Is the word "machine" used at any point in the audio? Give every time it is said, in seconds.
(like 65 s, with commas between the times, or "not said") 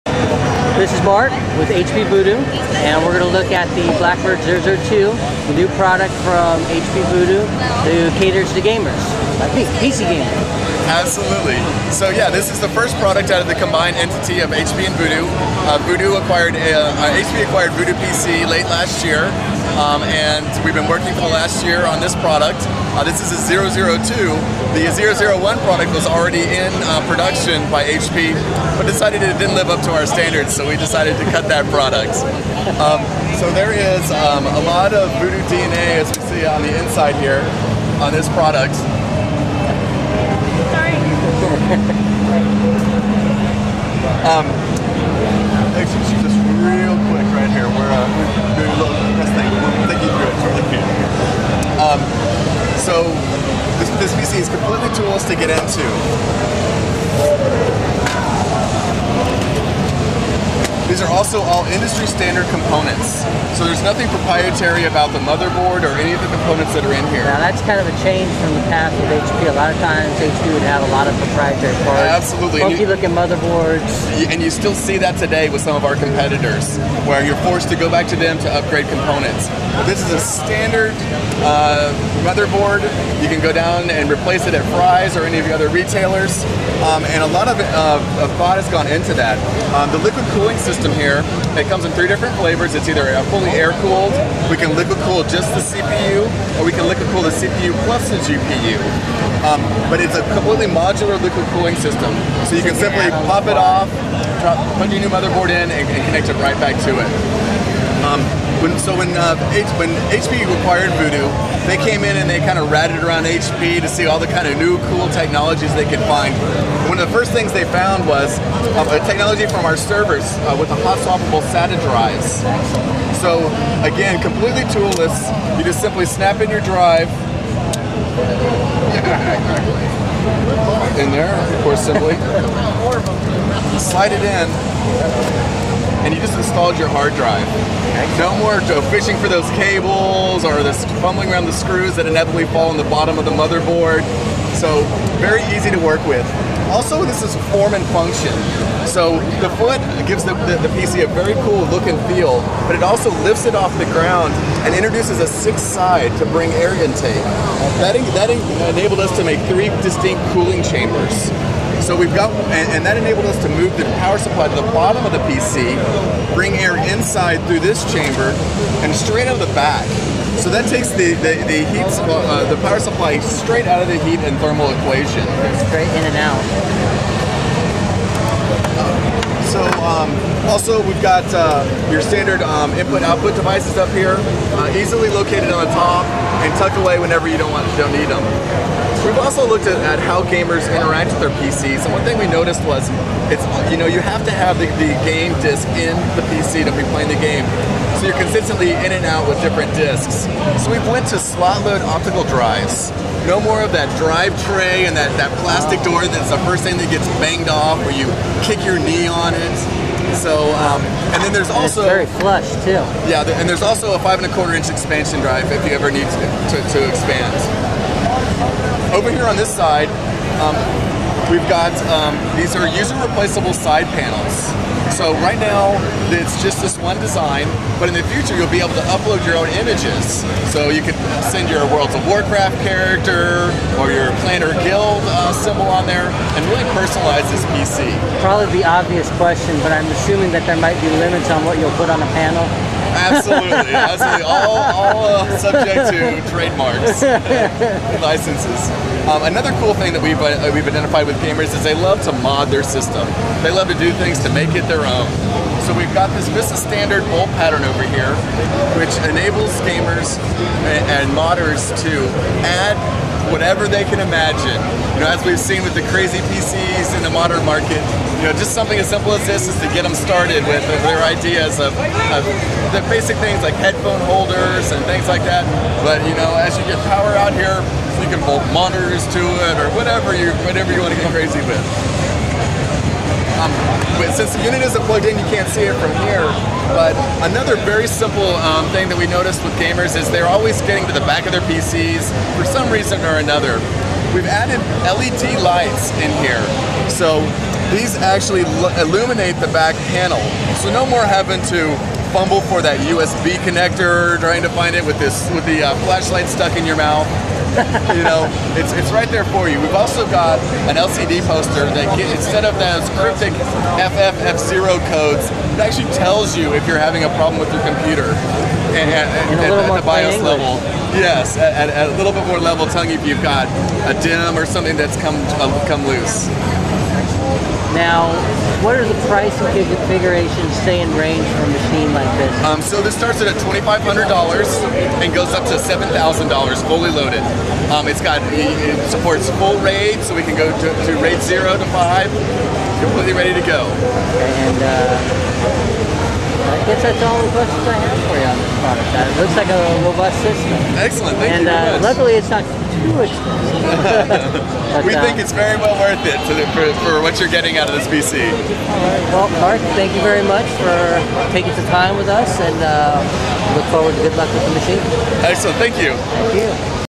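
331 s, 364 s.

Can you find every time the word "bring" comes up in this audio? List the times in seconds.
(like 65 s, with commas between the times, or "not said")
156 s, 166 s.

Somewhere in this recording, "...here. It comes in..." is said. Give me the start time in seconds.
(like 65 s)
91 s.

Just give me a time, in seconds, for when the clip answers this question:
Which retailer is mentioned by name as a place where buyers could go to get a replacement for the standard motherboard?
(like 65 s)
84 s.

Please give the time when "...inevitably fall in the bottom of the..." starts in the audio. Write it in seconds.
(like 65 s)
142 s.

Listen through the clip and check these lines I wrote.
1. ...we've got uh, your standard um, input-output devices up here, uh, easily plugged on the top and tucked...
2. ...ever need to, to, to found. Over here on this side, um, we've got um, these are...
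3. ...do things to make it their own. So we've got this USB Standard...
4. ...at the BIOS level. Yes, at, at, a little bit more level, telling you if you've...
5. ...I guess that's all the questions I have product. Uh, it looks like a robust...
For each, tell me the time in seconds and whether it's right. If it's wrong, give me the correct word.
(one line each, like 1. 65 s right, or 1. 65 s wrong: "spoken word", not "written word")
1. 180 s wrong: "located", not "plugged"
2. 215 s wrong: "expand", not "found"
3. 253 s wrong: "VESA", not "USB"
4. 319 s right
5. 346 s right.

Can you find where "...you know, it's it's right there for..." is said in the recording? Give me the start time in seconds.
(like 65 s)
307 s.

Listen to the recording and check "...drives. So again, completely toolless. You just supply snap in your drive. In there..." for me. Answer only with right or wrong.
wrong.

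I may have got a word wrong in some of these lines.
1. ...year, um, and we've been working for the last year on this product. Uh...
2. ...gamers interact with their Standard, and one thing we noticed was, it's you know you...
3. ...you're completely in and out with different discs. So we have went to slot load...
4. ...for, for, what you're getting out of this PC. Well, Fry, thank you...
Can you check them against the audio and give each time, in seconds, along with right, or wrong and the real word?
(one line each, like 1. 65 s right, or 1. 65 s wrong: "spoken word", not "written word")
1. 19 s right
2. 190 s wrong: "PCs", not "Standard"
3. 198 s wrong: "consistently", not "completely"
4. 356 s wrong: "Mark", not "Fry".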